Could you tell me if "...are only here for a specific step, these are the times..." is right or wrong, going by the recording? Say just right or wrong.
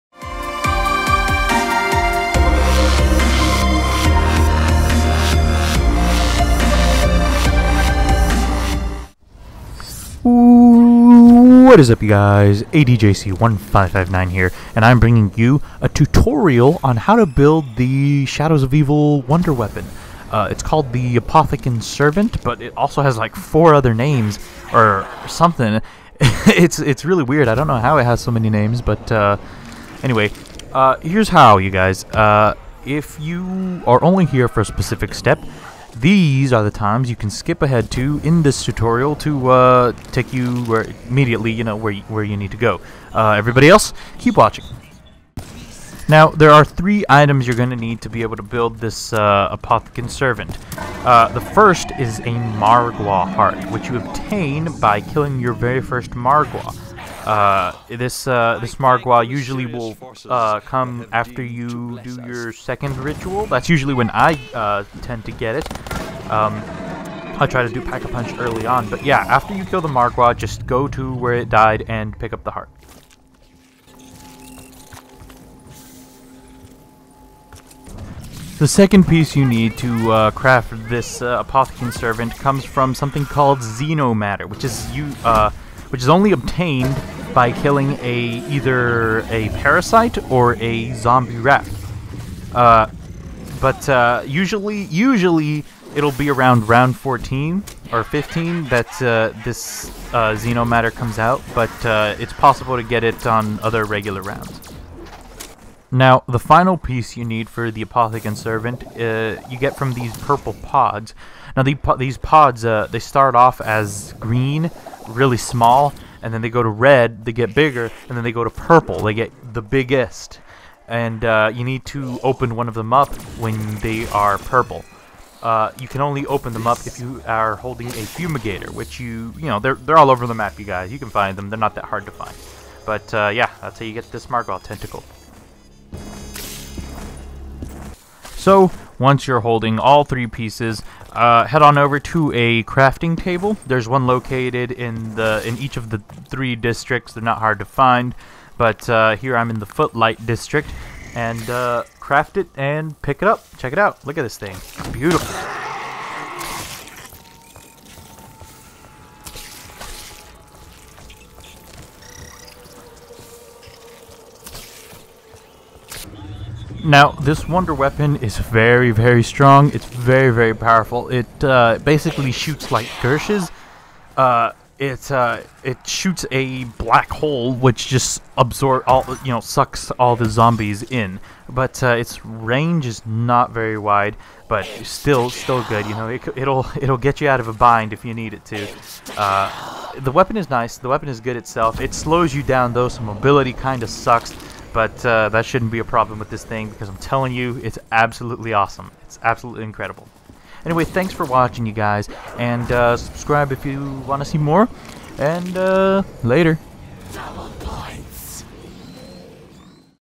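right.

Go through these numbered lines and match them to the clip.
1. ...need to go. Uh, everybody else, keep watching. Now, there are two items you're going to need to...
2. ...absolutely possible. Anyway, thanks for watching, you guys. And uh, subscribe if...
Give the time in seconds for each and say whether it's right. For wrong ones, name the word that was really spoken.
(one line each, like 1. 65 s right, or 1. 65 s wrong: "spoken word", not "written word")
1. 42 s wrong: "three", not "two"
2. 199 s wrong: "incredible", not "possible".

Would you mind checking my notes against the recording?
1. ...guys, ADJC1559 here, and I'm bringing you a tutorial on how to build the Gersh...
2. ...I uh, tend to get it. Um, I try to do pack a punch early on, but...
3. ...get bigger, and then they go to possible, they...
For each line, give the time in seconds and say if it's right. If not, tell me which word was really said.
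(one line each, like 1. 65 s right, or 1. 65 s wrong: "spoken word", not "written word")
1. 12 s wrong: "Shadows", not "Gersh"
2. 64 s right
3. 117 s wrong: "purple", not "possible".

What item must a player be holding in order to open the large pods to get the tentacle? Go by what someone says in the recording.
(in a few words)
A fumigator.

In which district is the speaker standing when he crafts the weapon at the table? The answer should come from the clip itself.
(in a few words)
Footlight district.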